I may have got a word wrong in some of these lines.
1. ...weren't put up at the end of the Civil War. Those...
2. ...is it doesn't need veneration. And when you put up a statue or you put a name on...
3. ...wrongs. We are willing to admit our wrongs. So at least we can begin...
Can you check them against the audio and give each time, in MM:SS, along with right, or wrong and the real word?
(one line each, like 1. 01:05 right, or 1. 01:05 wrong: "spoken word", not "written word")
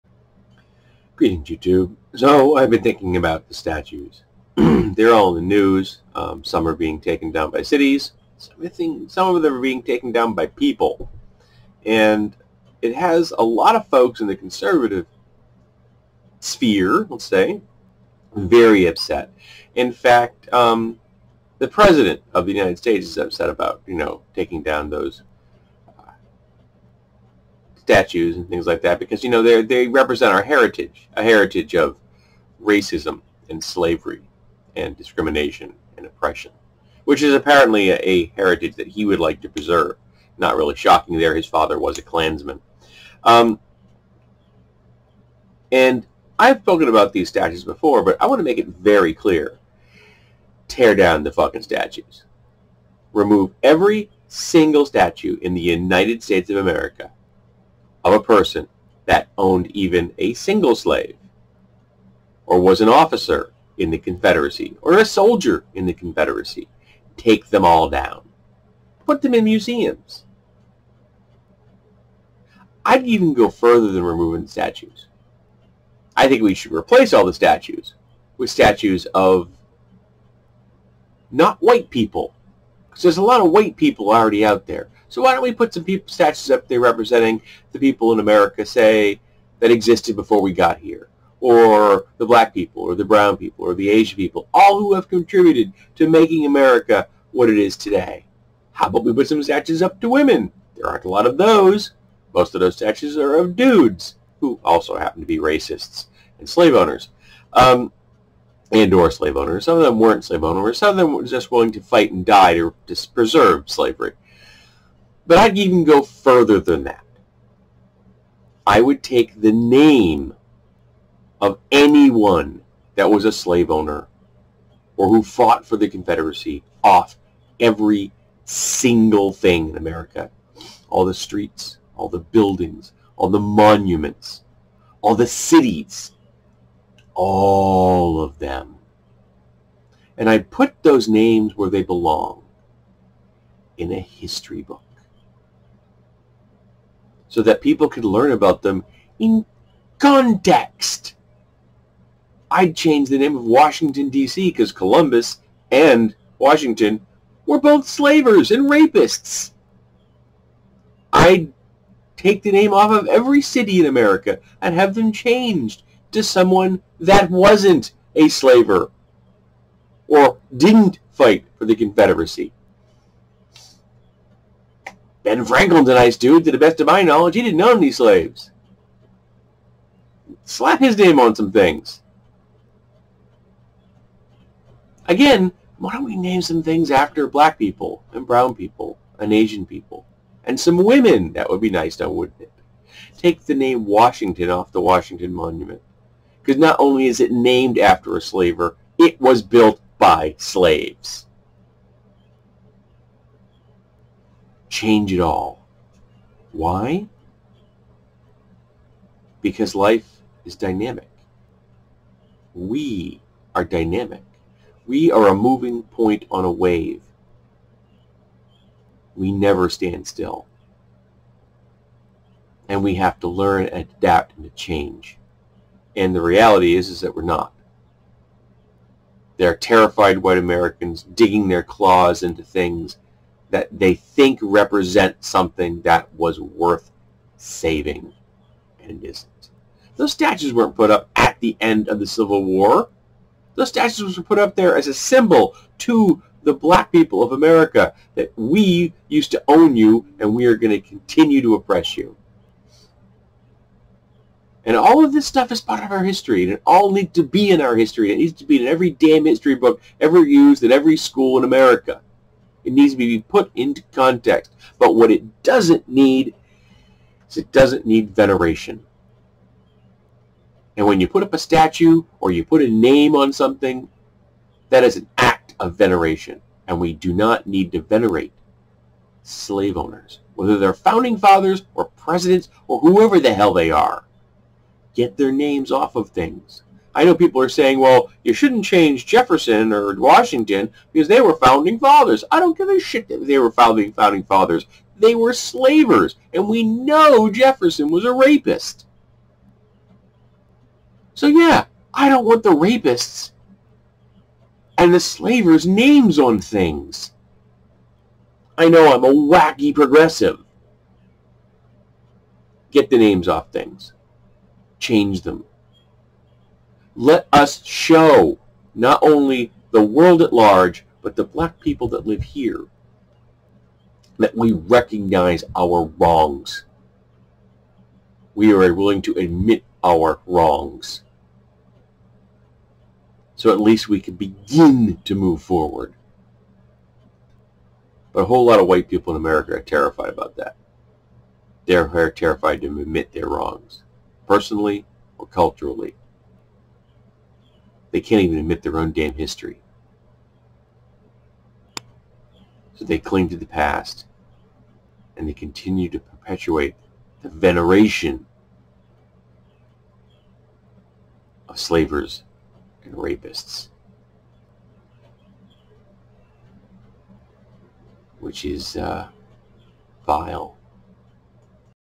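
1. 04:00 right
2. 04:27 right
3. 05:25 right.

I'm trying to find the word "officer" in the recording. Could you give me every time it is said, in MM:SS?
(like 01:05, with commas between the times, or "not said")
01:02.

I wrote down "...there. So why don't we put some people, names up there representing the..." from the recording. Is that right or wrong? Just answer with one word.
wrong.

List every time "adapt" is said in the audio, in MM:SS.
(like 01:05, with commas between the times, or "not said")
03:43.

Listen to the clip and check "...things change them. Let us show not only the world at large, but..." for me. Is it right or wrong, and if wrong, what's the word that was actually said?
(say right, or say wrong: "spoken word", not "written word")
right.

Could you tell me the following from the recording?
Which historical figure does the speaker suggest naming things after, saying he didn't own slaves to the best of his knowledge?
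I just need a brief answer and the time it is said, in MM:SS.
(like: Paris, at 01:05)
Ben Franklin, at 02:55.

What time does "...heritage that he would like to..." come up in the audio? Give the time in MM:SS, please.
00:38.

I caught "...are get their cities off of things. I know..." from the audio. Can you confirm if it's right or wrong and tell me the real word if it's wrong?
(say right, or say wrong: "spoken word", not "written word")
wrong: "names", not "cities".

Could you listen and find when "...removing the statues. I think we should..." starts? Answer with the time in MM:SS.
01:14.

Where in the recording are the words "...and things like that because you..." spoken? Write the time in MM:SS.
00:28.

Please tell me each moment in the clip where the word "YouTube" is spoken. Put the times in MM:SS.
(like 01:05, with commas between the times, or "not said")
00:01.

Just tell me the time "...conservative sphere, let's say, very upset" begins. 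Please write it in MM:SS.
00:14.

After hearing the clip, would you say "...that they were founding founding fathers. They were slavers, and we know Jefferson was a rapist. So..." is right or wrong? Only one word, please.
right.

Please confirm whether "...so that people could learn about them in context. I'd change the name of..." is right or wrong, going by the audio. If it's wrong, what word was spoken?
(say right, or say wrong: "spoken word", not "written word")
right.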